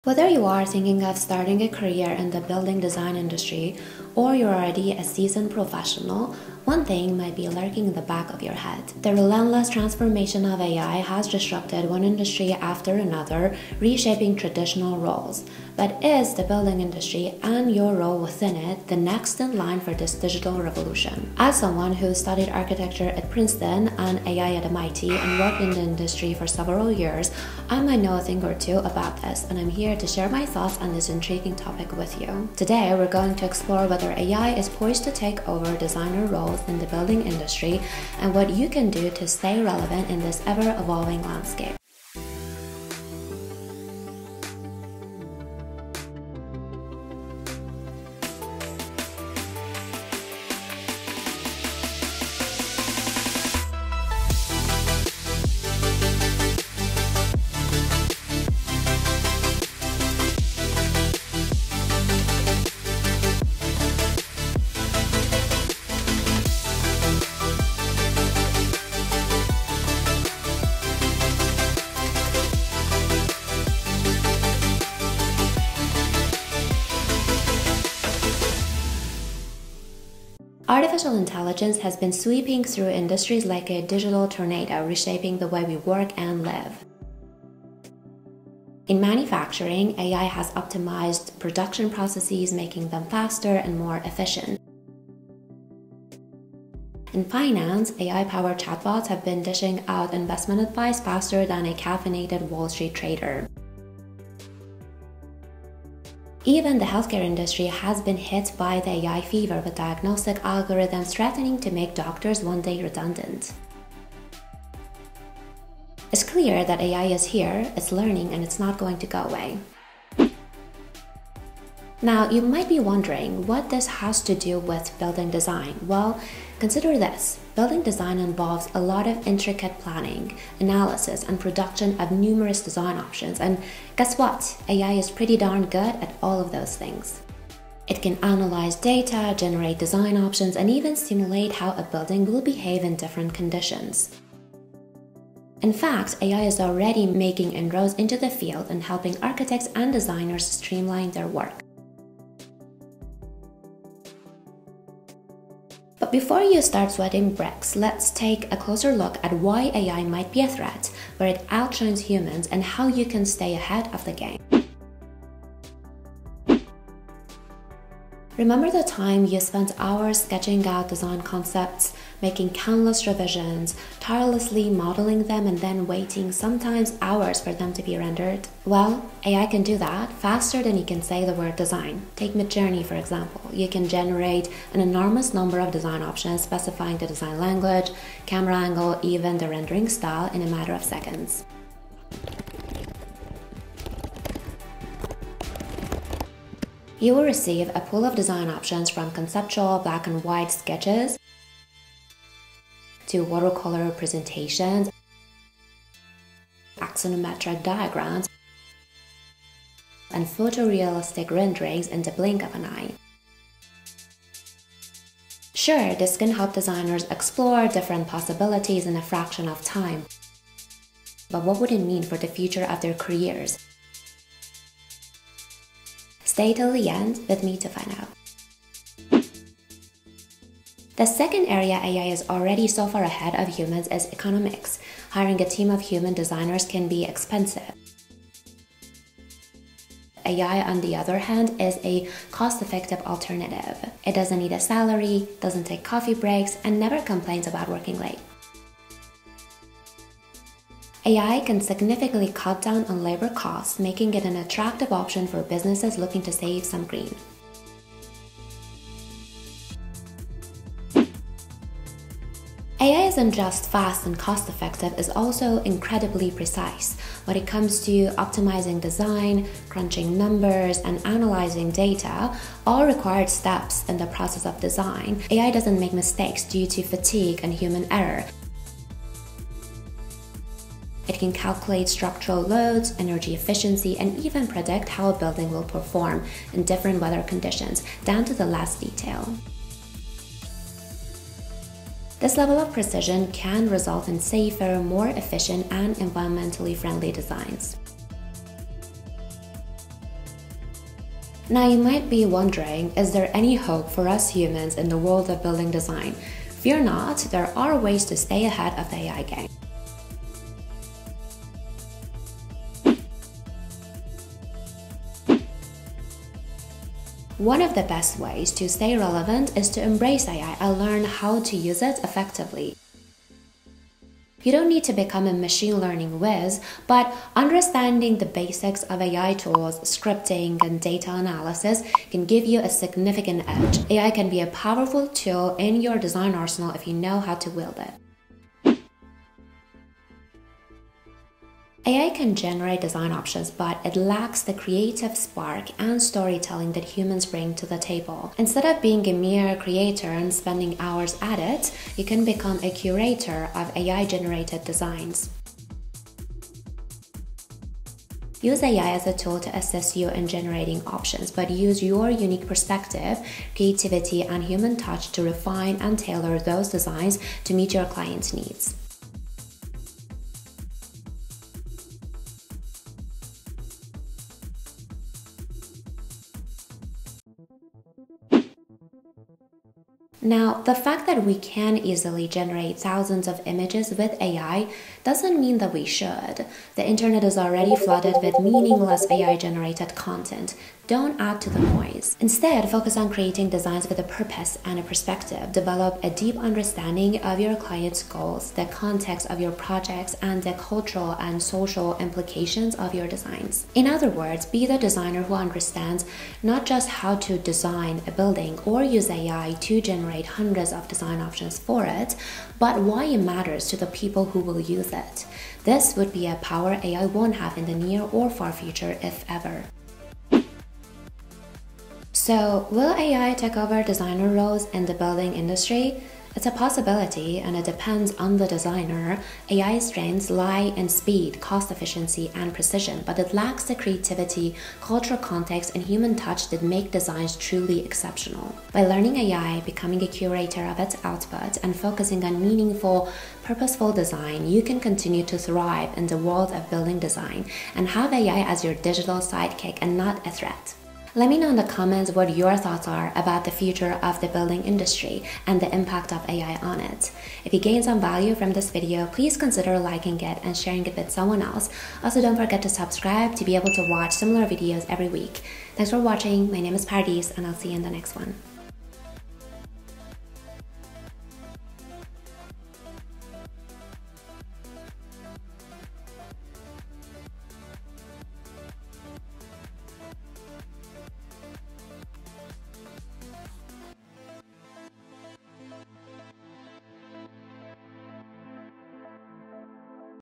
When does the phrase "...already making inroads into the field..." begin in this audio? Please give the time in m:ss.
2:26.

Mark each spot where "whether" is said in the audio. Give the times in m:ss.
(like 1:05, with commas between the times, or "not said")
0:00, 0:33.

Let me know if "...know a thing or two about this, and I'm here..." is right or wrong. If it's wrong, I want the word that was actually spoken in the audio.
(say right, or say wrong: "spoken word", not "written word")
right.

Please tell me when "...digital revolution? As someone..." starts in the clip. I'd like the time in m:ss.
0:20.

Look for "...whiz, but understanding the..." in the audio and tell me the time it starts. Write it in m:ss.
5:26.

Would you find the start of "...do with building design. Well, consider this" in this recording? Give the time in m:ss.
2:04.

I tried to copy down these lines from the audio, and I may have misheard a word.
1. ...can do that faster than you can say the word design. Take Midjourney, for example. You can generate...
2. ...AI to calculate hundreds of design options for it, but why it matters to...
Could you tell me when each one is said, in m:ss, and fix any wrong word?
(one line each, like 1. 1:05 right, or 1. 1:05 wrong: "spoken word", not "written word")
1. 2:59 right
2. 6:49 wrong: "generate", not "calculate".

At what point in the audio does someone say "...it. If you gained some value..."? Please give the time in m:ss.
7:36.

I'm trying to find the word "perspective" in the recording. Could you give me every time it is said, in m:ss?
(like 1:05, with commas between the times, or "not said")
6:02, 6:34.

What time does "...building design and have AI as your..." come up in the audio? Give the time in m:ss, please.
7:26.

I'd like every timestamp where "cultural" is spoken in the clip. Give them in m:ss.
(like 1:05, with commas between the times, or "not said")
6:40, 7:14.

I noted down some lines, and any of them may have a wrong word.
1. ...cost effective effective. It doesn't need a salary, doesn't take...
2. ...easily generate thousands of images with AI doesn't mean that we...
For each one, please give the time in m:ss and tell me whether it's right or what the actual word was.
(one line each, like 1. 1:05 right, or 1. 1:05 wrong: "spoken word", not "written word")
1. 4:02 wrong: "alternative", not "effective"
2. 6:21 right.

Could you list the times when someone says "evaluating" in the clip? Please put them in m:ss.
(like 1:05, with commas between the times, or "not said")
not said.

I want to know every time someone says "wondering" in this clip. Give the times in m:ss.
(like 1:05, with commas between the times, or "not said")
2:02, 5:02.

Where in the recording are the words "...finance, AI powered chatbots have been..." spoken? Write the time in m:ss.
1:37.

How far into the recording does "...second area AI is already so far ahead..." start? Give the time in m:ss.
3:51.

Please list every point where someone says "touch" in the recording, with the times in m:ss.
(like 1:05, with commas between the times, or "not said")
6:04, 7:16.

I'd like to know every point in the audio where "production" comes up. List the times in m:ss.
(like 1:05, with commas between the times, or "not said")
1:31, 2:11.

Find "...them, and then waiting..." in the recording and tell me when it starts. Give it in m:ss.
2:55.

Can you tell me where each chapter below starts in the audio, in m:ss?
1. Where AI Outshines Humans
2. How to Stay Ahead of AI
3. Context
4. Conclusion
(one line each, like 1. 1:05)
1. 2:45
2. 5:13
3. 2:00
4. 7:00.